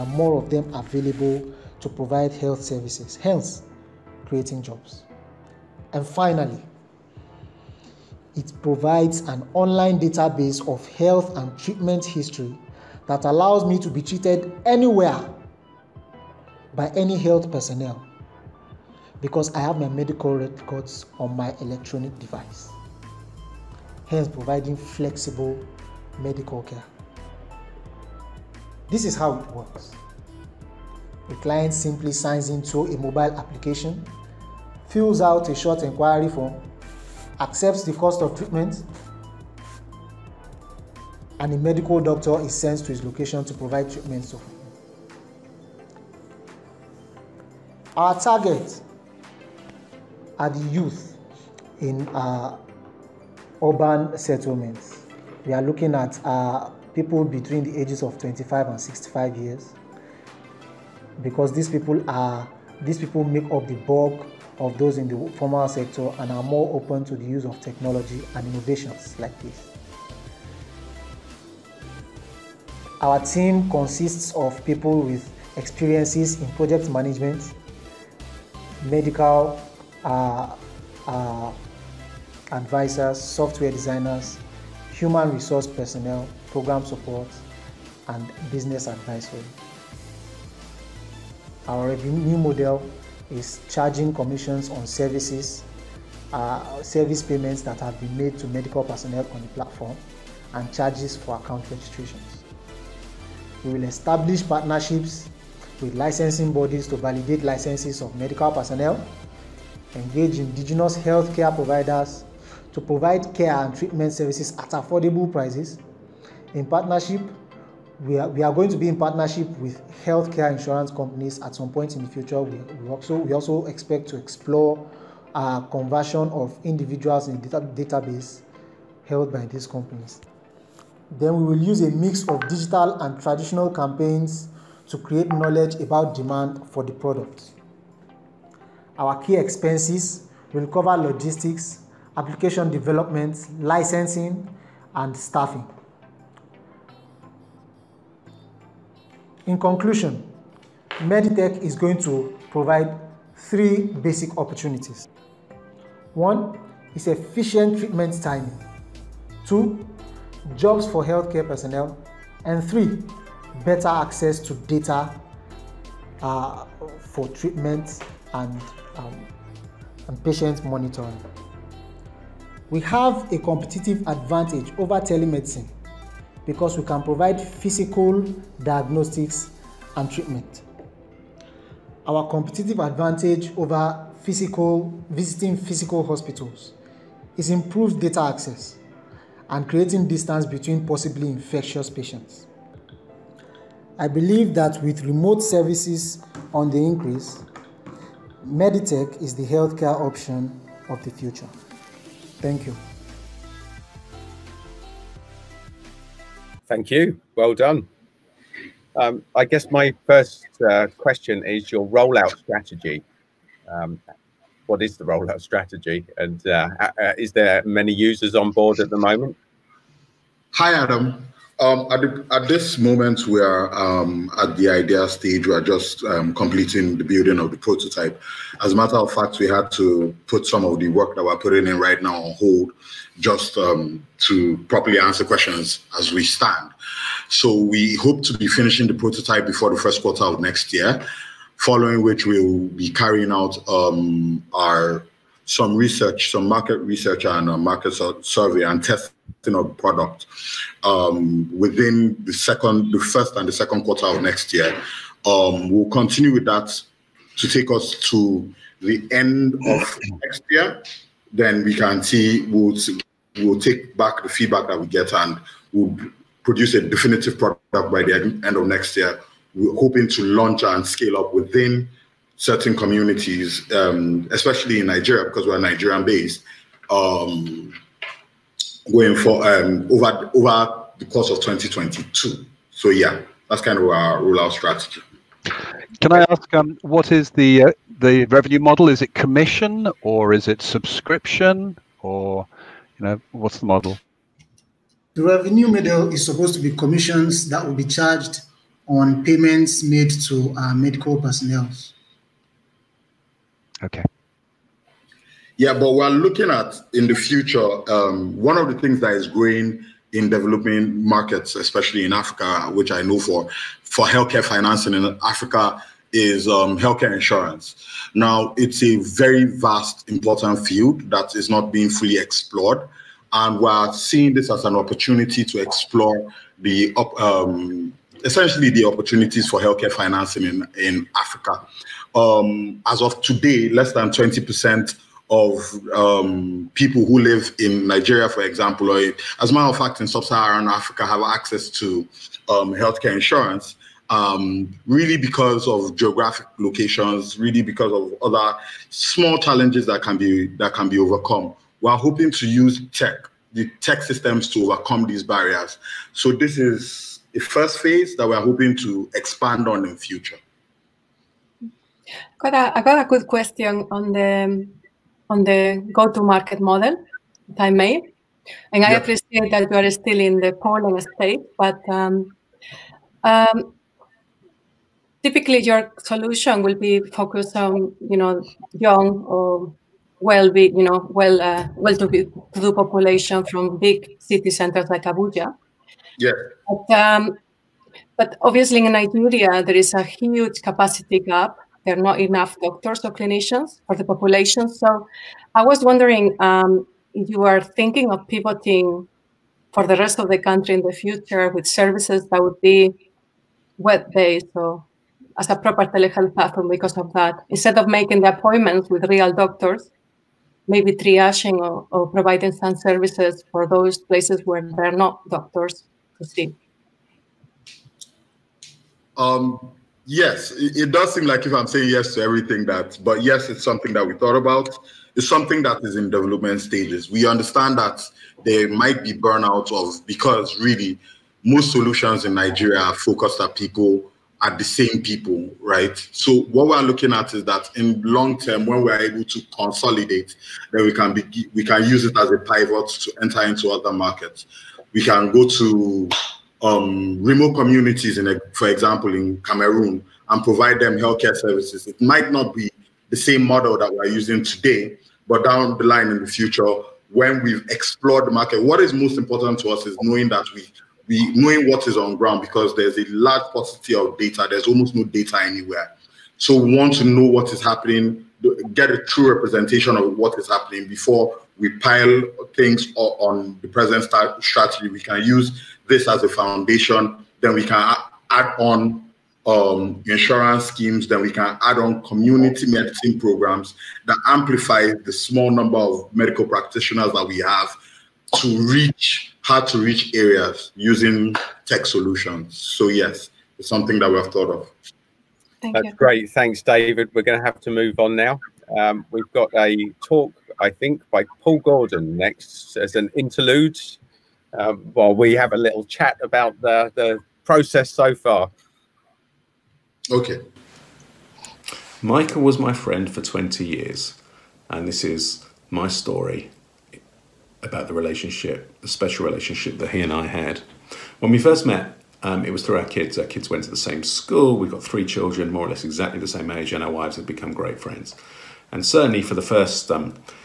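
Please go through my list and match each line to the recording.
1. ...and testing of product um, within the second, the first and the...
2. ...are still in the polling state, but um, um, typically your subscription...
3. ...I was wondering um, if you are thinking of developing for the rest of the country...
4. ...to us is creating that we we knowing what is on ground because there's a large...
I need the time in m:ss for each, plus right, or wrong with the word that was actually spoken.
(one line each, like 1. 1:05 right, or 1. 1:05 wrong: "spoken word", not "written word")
1. 4:08 right
2. 6:09 wrong: "solution", not "subscription"
3. 6:35 wrong: "pivoting", not "developing"
4. 7:39 wrong: "knowing", not "creating".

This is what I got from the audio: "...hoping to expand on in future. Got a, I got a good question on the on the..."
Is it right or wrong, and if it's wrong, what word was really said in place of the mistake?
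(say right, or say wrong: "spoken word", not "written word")
right.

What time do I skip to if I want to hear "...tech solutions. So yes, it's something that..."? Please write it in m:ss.
8:11.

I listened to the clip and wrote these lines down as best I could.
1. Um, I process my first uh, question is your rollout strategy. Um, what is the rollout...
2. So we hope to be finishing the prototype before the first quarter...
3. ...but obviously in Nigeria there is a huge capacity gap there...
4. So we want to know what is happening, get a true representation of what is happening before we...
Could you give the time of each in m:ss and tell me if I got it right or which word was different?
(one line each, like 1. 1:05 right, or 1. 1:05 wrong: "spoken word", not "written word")
1. 3:28 wrong: "guess", not "process"
2. 3:57 right
3. 6:28 right
4. 7:46 right.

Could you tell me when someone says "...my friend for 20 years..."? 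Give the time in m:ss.
8:32.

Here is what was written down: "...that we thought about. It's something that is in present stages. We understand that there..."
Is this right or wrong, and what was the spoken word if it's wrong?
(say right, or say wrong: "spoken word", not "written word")
wrong: "development", not "present".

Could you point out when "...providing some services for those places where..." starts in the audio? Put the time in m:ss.
6:52.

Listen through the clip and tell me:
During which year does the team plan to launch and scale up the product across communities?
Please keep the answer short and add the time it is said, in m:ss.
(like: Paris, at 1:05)
2022, at 4:41.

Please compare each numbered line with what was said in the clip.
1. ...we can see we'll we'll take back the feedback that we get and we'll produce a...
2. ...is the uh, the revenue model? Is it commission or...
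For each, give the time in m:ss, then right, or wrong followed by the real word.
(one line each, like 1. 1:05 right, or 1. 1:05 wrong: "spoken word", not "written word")
1. 4:21 right
2. 4:47 right.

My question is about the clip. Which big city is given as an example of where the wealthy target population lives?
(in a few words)
Abuja.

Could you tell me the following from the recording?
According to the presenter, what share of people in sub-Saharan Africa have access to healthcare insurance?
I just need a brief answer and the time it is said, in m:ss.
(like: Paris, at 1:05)
Less than 20%, at 5:33.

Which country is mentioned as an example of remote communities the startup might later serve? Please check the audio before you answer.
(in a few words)
Cameroon.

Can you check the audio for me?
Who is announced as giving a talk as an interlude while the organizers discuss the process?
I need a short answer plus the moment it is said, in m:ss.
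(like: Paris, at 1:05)
Paul Gordon, at 8:21.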